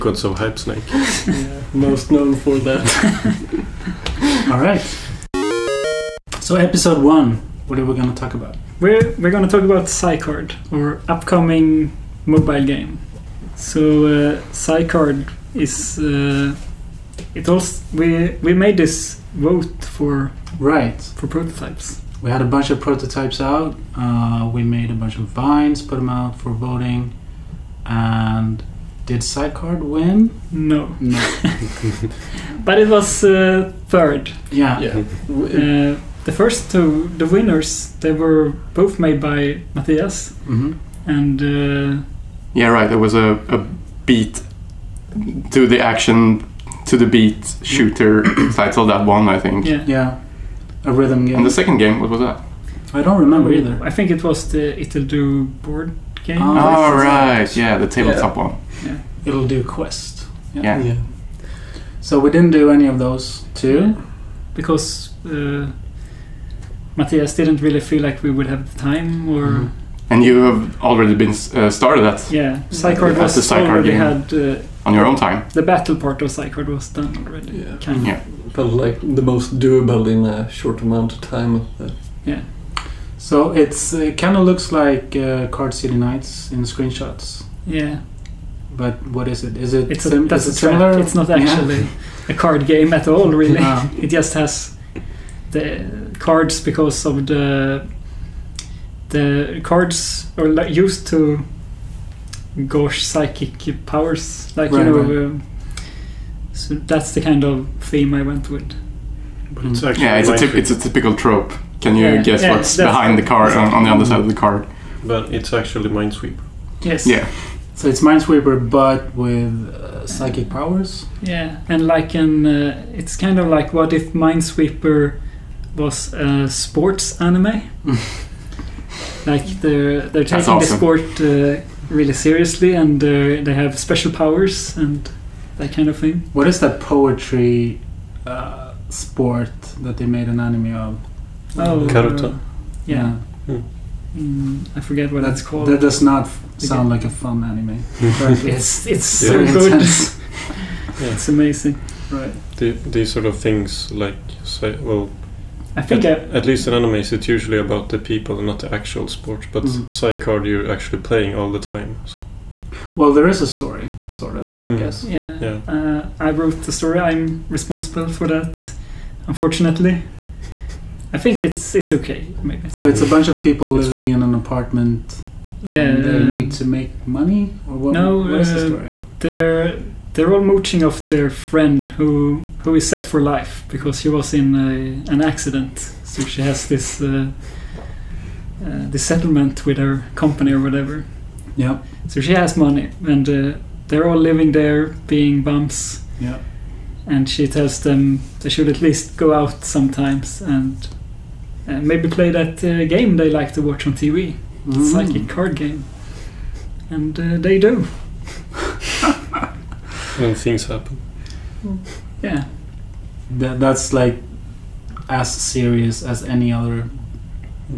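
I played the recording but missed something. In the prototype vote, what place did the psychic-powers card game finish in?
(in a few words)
Third.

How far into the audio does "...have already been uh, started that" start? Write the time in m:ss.
1:10.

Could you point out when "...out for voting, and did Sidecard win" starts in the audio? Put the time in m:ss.
0:26.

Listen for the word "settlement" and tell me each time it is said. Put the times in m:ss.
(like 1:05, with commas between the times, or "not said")
3:09.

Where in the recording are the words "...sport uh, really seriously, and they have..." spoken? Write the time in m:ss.
2:10.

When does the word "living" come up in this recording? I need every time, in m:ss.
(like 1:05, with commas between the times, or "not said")
2:53, 3:14.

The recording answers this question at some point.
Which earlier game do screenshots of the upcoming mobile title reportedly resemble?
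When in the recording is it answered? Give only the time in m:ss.
1:25.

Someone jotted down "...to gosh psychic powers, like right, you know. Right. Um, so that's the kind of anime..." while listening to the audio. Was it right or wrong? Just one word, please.
wrong.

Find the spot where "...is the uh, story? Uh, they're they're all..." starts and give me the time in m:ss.
2:58.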